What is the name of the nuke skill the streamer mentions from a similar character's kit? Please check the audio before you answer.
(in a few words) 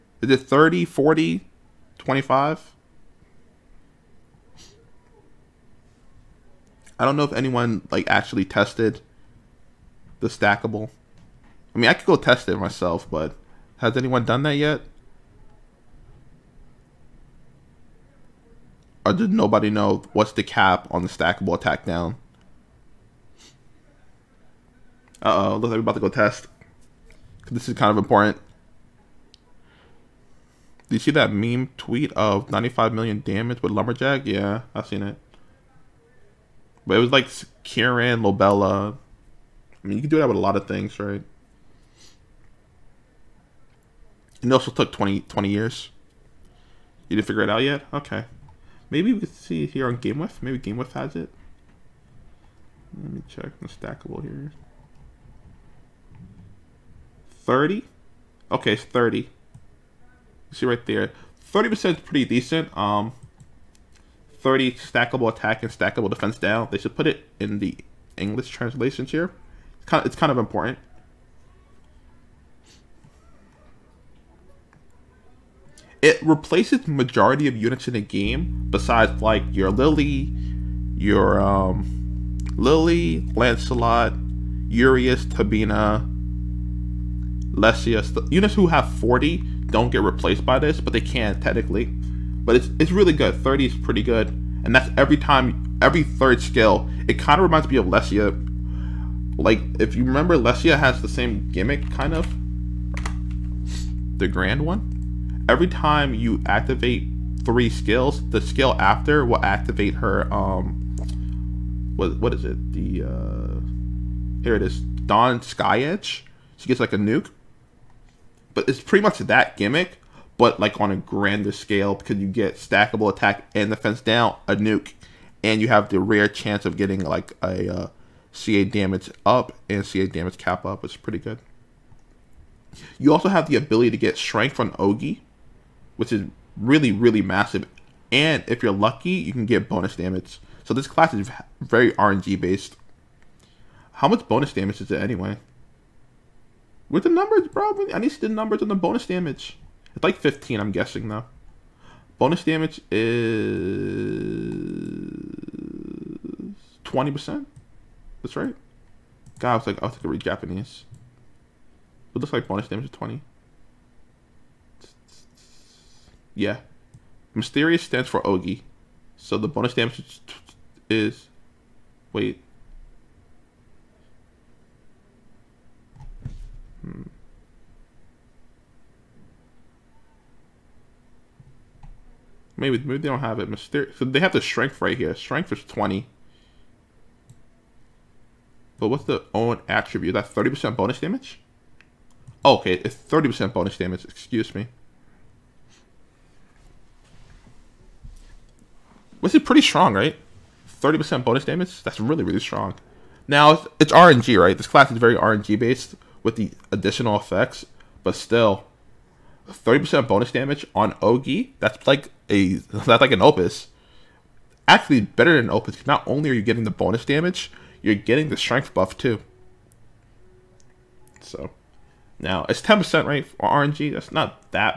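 Dawn Sky Edge.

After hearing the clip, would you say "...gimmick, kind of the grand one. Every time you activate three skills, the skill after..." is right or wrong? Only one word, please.
right.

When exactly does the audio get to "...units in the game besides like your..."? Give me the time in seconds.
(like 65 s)
77 s.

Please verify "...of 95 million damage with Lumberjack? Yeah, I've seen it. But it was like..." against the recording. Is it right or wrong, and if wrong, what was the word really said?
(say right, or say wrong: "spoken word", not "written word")
right.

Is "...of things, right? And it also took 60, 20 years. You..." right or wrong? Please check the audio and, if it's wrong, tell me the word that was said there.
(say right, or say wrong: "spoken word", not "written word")
wrong: "20", not "60".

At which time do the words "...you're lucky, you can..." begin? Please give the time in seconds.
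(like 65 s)
138 s.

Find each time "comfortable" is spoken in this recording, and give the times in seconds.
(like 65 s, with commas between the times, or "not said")
not said.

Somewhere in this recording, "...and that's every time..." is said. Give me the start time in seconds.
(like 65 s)
94 s.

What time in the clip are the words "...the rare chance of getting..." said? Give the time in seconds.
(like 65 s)
125 s.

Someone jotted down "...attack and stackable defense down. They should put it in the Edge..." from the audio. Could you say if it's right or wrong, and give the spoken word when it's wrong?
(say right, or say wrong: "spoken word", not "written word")
wrong: "English", not "Edge".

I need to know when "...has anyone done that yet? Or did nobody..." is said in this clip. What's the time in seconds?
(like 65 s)
13 s.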